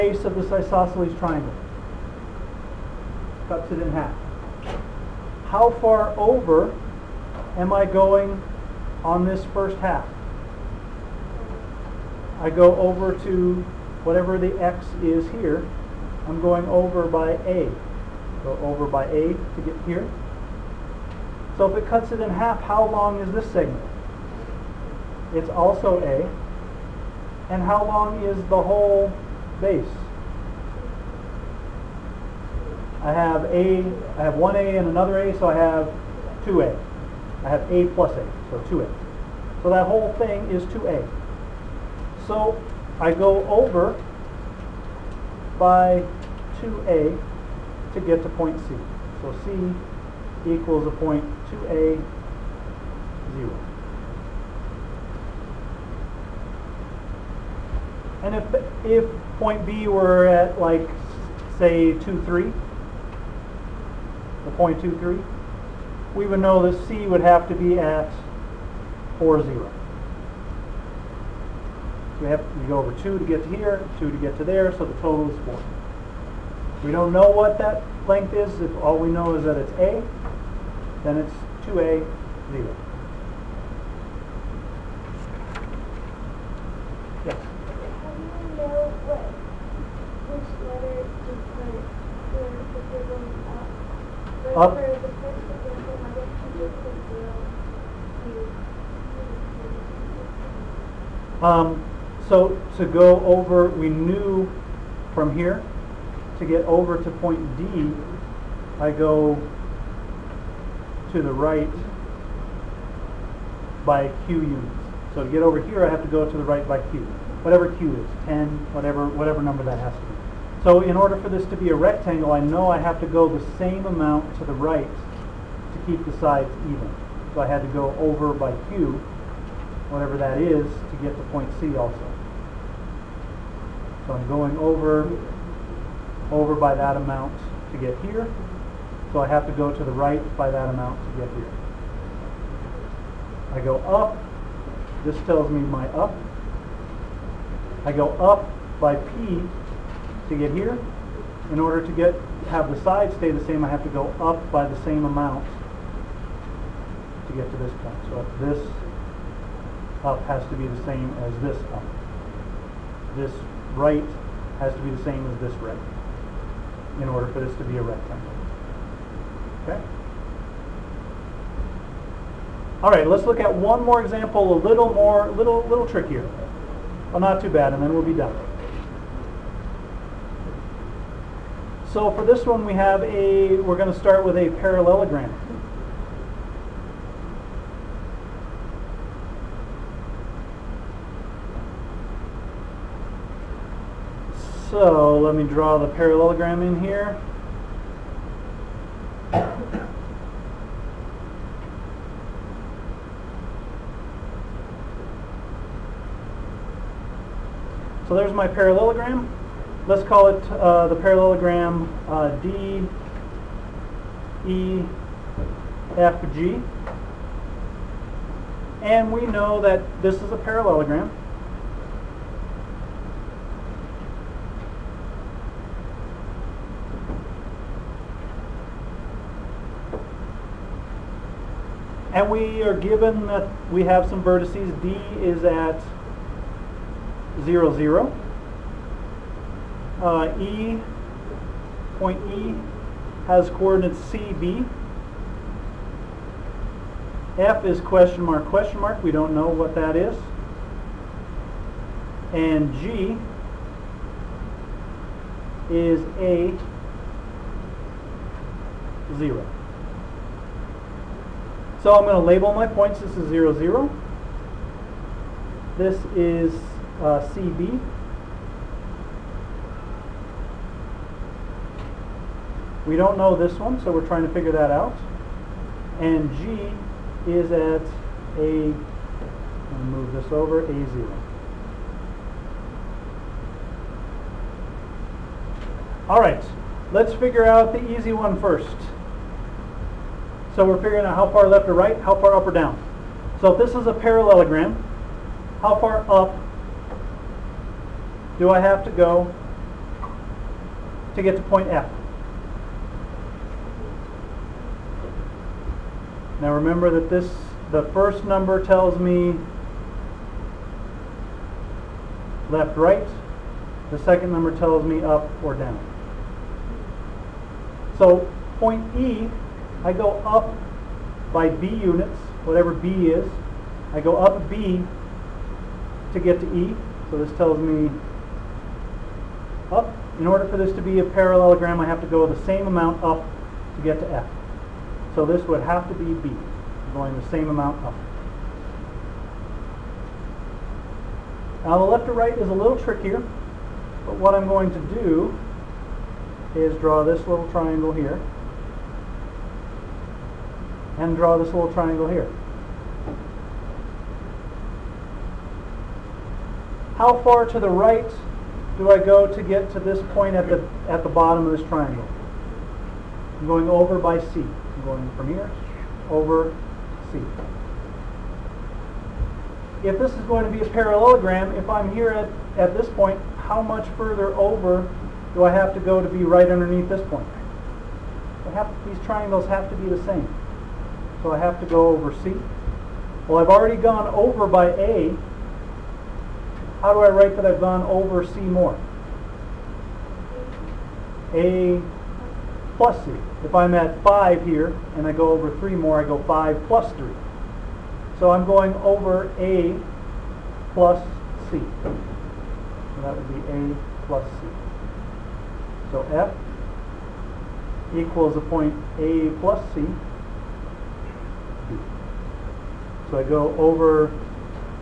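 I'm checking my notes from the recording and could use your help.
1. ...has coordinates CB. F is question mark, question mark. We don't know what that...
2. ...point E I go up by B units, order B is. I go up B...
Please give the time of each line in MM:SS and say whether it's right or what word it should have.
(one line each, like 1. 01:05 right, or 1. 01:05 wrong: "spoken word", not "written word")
1. 04:03 right
2. 05:18 wrong: "whatever", not "order".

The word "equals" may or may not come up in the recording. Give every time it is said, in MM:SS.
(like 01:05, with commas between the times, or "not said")
00:50, 06:47.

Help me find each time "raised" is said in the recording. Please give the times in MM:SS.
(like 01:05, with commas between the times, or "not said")
not said.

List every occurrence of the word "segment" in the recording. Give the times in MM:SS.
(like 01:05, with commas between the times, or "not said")
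00:23.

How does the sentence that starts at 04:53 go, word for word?
So if this is a parallelogram, how far up do I have to go to get to point F?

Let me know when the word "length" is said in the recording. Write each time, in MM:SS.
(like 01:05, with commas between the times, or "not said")
01:18.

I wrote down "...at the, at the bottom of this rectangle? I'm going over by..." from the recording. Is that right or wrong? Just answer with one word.
wrong.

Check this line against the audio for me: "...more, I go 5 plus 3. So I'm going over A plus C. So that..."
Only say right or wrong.
right.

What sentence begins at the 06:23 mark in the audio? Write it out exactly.
Well, I've already gone over by A.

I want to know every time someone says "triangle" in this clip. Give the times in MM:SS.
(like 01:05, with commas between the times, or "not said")
00:01, 05:47, 05:51, 06:01, 06:19.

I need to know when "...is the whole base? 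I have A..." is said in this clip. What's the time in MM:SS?
00:28.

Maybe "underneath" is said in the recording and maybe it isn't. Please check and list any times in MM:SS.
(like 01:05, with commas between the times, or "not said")
06:16.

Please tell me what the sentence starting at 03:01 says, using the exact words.
So for this one, we have a, we're going to start with a parallelogram.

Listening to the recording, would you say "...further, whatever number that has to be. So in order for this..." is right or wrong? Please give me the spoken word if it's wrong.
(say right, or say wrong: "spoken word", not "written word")
wrong: "whatever", not "further".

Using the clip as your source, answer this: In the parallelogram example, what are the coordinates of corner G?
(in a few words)
A, 0.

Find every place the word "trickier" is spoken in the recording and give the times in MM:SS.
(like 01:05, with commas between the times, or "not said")
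02:55, 05:42.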